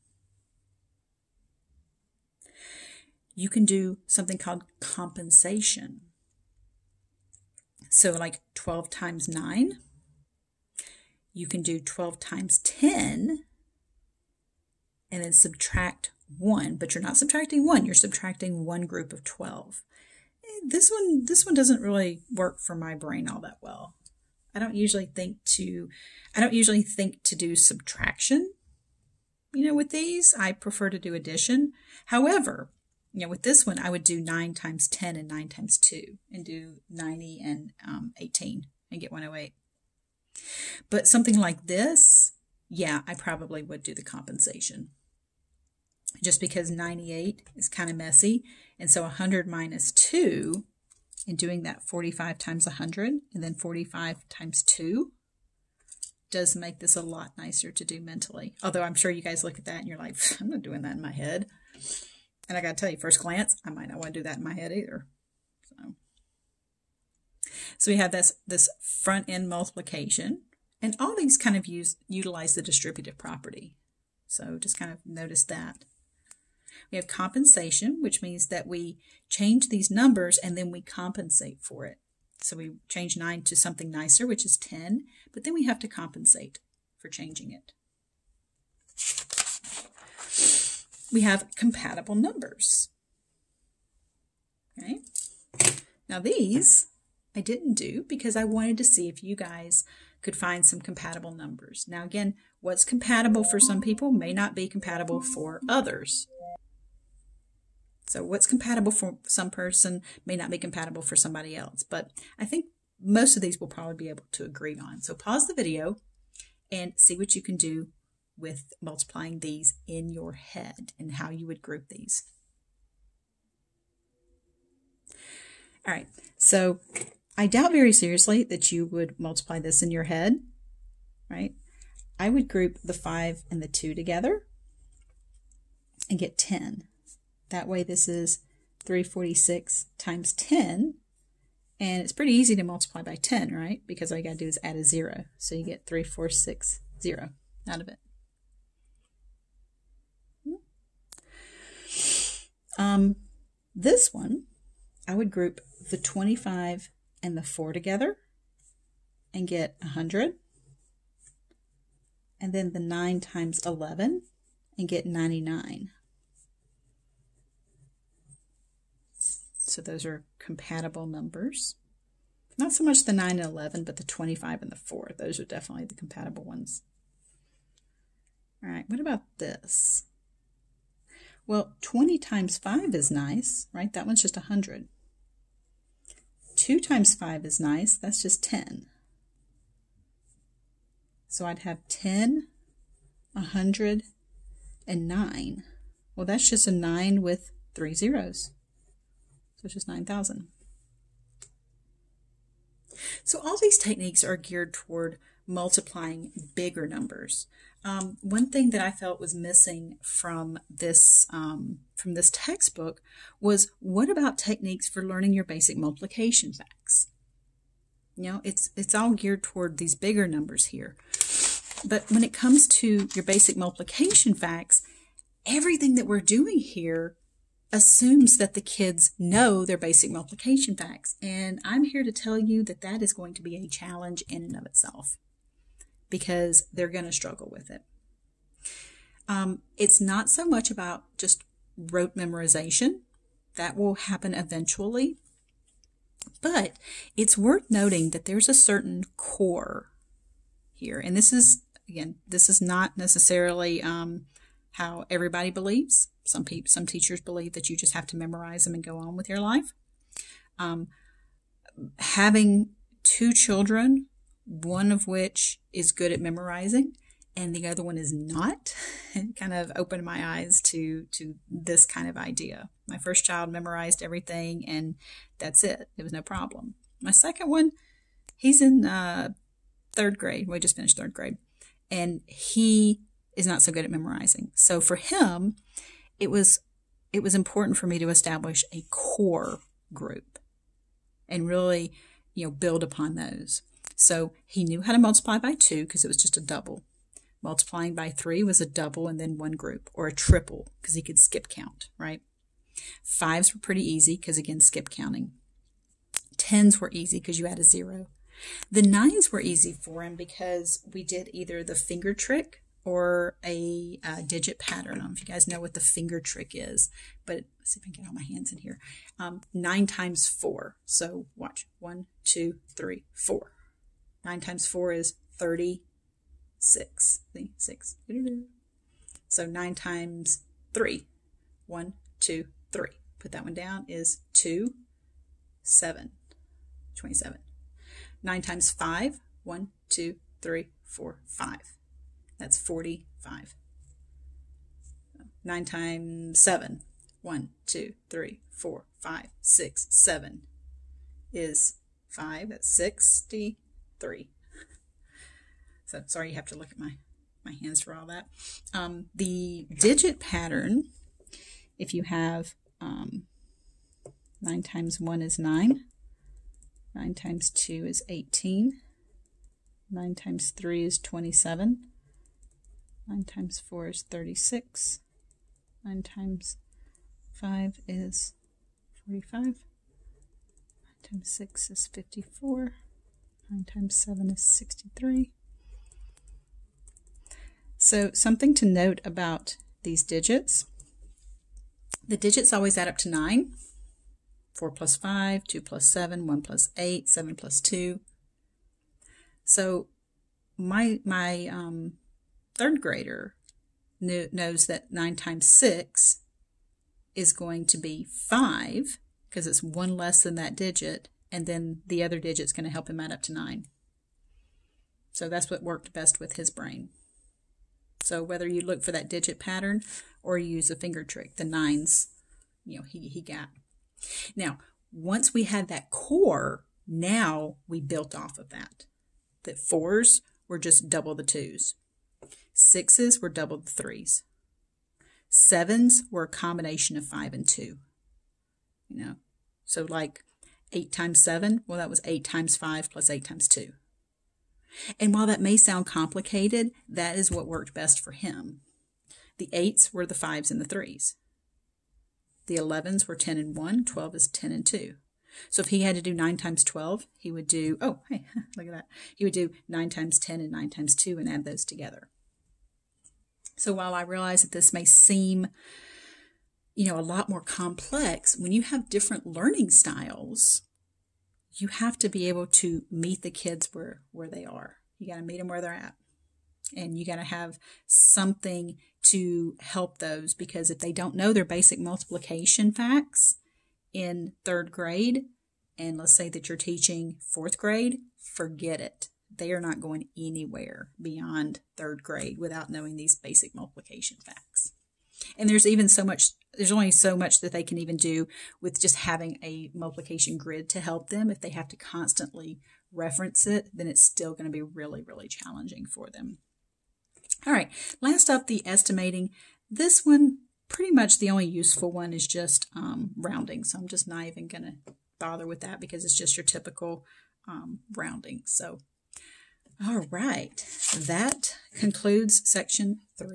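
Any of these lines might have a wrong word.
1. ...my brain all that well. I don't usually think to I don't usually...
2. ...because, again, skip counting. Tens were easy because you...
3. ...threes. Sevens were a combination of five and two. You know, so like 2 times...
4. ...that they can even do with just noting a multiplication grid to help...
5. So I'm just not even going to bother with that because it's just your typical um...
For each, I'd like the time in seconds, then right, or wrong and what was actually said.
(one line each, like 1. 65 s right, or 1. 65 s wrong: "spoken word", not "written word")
1. 22 s right
2. 304 s right
3. 433 s wrong: "8", not "2"
4. 497 s wrong: "having", not "noting"
5. 513 s right.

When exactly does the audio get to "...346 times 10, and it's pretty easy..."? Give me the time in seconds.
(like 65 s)
138 s.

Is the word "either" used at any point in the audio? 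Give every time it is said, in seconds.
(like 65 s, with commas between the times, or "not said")
64 s, 311 s.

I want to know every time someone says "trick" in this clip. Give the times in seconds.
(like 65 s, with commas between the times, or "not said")
312 s, 316 s, 421 s.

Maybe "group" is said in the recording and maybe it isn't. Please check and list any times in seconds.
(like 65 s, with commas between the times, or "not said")
18 s, 121 s, 132 s, 155 s, 289 s, 299 s.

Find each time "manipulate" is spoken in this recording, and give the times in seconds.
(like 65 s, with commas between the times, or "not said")
not said.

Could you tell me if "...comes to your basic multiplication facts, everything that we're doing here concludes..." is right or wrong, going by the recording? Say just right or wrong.
wrong.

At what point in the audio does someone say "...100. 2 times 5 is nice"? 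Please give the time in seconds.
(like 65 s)
184 s.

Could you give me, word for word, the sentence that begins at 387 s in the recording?
So something to note about these digits.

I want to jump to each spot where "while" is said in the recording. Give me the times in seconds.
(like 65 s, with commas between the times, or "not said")
445 s, 463 s.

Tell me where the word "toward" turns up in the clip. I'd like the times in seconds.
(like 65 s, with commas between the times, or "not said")
204 s, 219 s.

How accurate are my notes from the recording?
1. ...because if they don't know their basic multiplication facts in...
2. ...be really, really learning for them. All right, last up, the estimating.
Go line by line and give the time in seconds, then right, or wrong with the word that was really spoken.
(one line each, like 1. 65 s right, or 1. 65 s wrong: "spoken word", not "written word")
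1. 480 s right
2. 504 s wrong: "challenging", not "learning".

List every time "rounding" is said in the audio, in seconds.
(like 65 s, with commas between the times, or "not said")
513 s, 517 s.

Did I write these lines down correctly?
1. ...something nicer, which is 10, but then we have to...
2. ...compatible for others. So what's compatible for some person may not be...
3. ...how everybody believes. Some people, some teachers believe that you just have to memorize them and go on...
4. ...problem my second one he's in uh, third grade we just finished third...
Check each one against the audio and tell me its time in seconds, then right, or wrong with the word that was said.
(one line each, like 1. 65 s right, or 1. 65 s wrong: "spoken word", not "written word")
1. 83 s right
2. 104 s right
3. 254 s right
4. 276 s right.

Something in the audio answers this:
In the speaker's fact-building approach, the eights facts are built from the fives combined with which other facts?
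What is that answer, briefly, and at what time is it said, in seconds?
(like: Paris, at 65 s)
the 3s, at 450 s.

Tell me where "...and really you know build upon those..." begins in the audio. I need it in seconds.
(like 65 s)
291 s.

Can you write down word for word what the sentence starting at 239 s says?
Um, it's not so much about just rote memorization, that will happen eventually.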